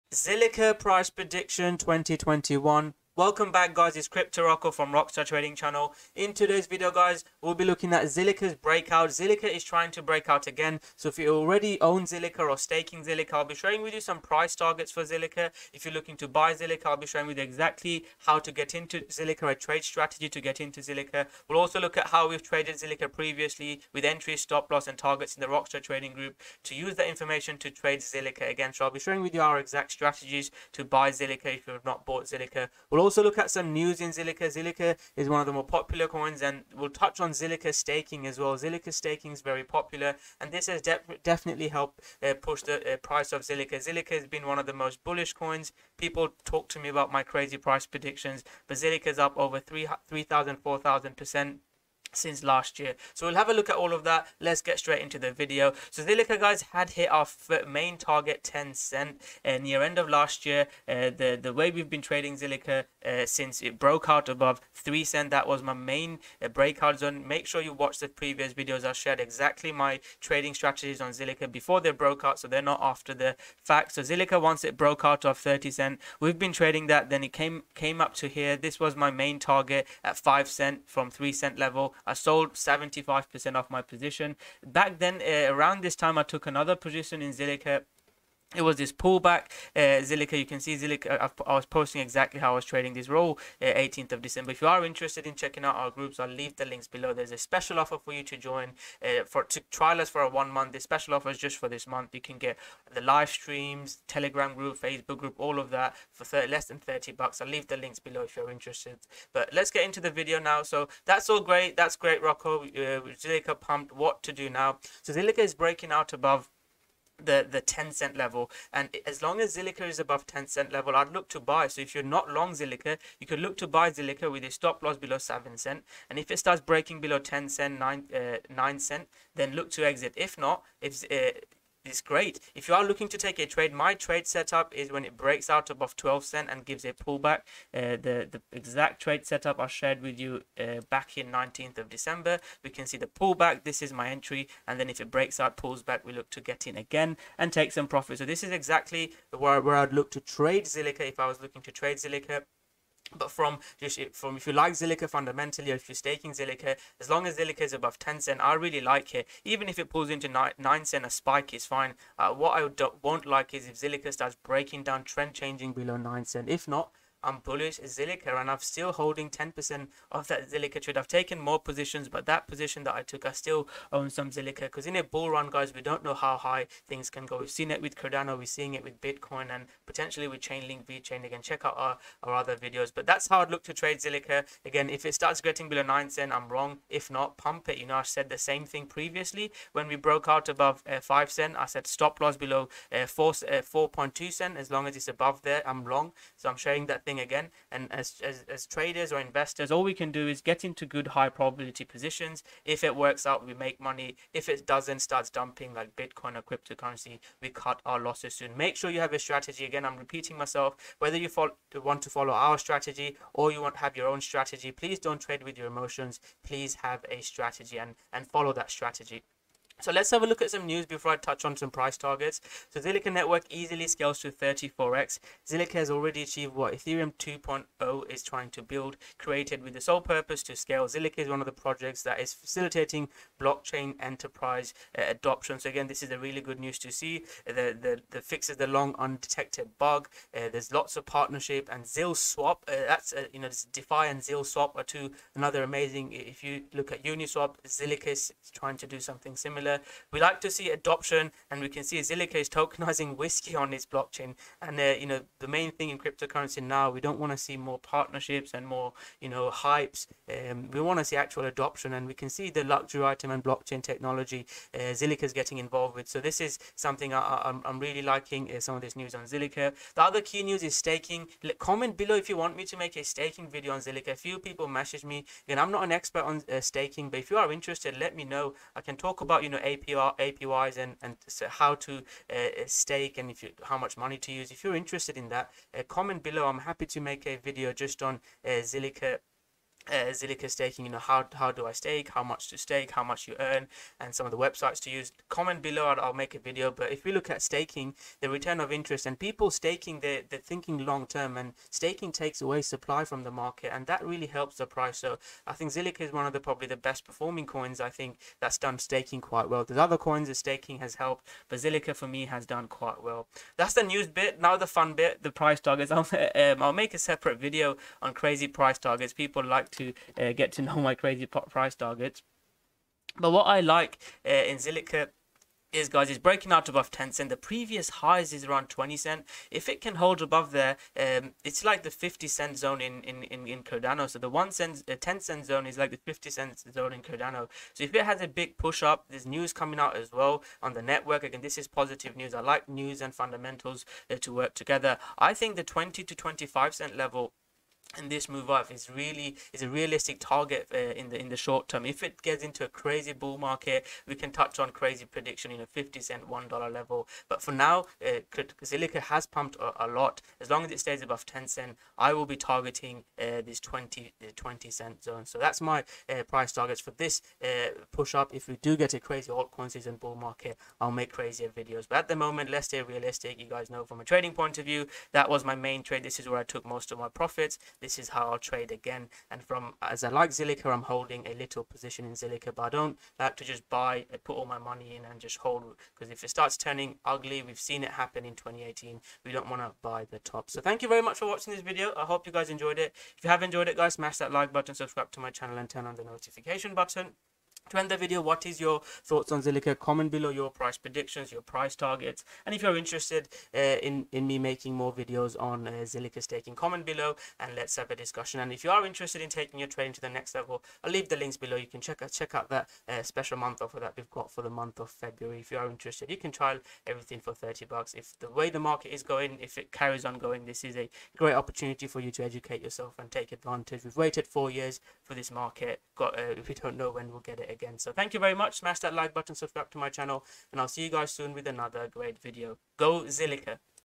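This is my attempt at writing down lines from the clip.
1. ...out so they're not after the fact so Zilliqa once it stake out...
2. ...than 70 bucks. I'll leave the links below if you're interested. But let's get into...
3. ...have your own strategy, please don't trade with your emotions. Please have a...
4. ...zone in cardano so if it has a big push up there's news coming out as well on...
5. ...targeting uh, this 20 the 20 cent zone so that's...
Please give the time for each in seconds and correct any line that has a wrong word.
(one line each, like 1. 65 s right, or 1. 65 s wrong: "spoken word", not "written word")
1. 72 s wrong: "broke", not "stake"
2. 106 s wrong: "30", not "70"
3. 213 s right
4. 336 s right
5. 362 s right.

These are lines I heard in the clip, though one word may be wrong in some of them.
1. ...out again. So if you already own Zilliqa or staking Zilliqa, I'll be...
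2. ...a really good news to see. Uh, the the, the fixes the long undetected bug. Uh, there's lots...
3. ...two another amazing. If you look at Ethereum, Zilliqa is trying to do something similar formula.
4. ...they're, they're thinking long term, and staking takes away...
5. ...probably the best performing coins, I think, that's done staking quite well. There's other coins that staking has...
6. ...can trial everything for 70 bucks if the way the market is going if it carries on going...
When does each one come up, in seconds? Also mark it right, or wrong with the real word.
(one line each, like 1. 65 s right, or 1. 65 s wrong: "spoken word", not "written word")
1. 10 s right
2. 236 s right
3. 244 s wrong: "Uniswap", not "Ethereum"
4. 300 s right
5. 306 s right
6. 416 s wrong: "30", not "70".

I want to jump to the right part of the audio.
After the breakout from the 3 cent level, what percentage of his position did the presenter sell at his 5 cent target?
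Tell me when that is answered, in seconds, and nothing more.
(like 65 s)
82 s.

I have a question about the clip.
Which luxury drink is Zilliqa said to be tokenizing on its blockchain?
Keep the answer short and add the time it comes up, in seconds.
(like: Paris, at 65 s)
Whiskey, at 253 s.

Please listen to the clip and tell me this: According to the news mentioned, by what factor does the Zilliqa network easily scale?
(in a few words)
34x.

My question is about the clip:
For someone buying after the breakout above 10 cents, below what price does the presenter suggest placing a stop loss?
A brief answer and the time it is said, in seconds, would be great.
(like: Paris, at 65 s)
7 cents, at 125 s.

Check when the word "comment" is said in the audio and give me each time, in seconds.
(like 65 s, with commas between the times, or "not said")
271 s, 285 s, 295 s, 399 s, 406 s.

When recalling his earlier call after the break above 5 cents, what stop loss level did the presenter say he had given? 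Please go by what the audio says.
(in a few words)
4.2 cents.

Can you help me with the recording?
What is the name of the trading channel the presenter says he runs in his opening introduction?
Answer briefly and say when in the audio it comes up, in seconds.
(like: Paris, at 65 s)
Rockstar Trading Channel, at 4 s.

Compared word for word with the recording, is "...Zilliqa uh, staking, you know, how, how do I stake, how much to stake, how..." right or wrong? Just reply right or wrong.
right.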